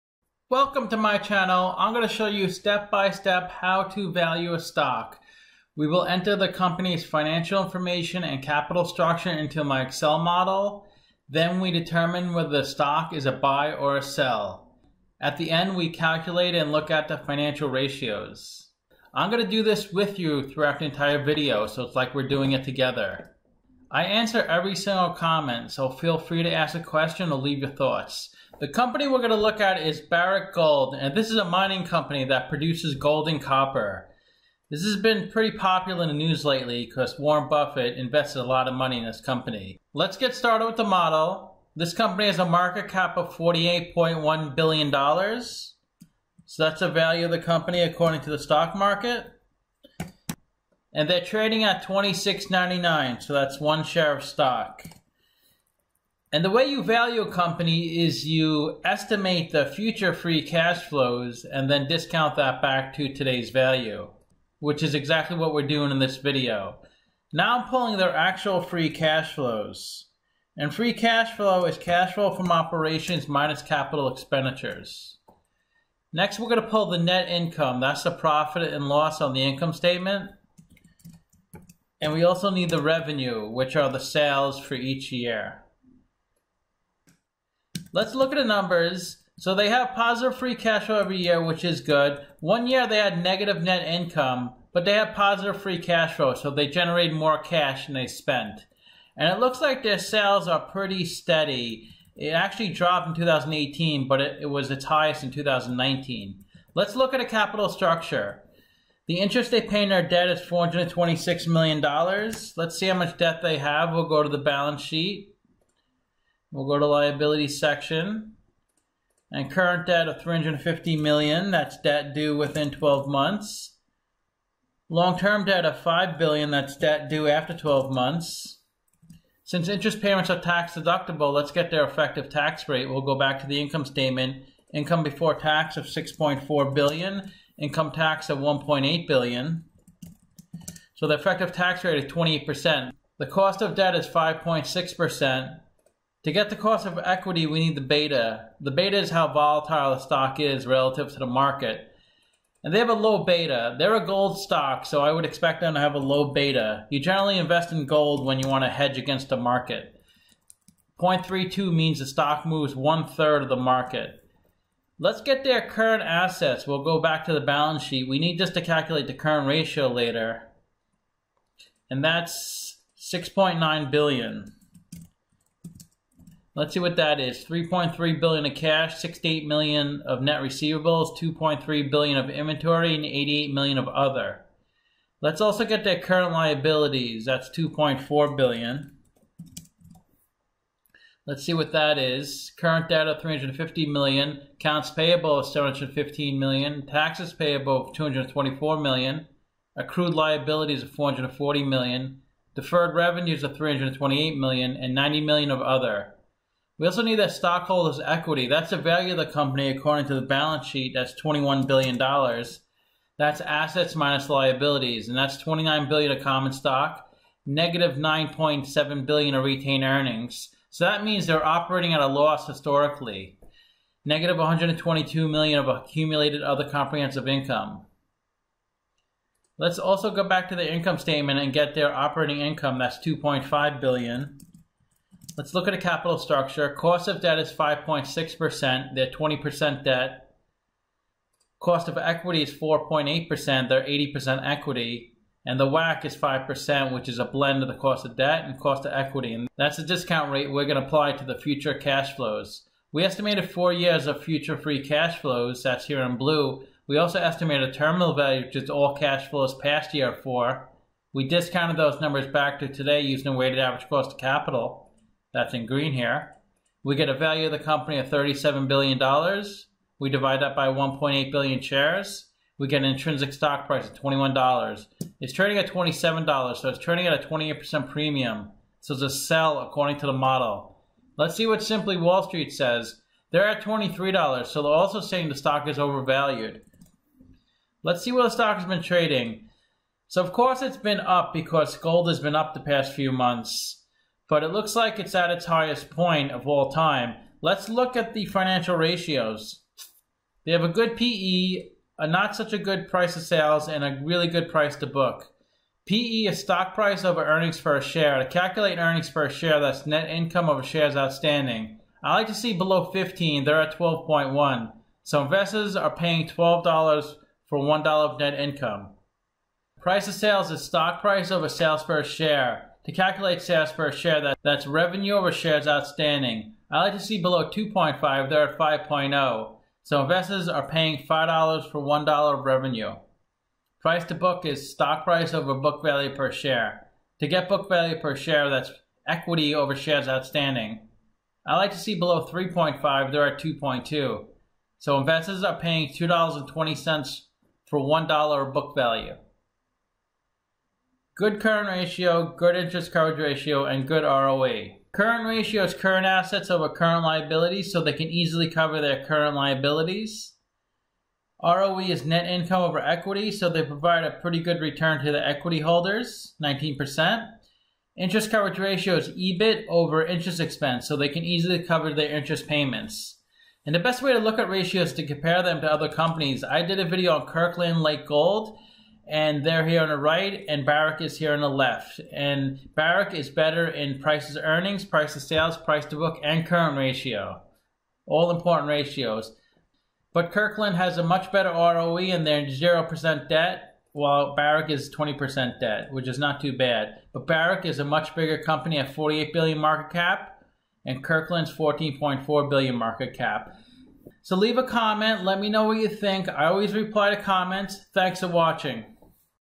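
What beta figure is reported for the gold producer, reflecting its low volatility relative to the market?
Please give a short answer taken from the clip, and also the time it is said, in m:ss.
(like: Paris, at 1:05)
0.32, at 2:40.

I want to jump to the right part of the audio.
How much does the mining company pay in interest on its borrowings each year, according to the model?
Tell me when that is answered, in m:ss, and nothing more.
1:50.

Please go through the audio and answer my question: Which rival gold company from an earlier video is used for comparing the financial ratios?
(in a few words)
Kirkland Lake Gold.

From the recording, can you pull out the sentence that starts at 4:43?
They're at $23, so they're also saying the stock is overvalued.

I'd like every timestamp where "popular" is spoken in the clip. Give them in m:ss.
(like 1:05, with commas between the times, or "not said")
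0:35.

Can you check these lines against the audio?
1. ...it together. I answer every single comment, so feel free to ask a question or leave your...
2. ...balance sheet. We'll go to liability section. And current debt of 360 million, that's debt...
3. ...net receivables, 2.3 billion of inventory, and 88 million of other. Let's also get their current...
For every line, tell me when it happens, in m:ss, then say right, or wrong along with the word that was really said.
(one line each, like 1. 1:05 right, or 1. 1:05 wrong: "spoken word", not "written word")
1. 0:22 right
2. 1:54 wrong: "350", not "360"
3. 3:00 right.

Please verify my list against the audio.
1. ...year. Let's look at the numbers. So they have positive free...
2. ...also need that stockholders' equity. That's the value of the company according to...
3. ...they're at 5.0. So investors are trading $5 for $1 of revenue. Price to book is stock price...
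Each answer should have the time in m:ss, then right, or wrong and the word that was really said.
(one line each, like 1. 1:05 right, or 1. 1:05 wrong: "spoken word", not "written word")
1. 1:25 right
2. 3:26 right
3. 5:28 wrong: "paying", not "trading".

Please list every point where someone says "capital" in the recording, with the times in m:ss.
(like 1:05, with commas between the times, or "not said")
0:08, 1:13, 1:47, 3:55, 4:24.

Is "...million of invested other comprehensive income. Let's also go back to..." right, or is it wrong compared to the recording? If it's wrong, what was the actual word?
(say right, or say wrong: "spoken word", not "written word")
wrong: "accumulated", not "invested".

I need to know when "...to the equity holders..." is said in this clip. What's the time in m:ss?
6:05.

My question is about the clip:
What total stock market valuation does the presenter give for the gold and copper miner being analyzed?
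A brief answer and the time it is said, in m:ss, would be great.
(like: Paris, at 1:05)
$48.1 billion, at 0:43.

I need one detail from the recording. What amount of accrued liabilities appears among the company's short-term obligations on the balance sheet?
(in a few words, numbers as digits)
440 million.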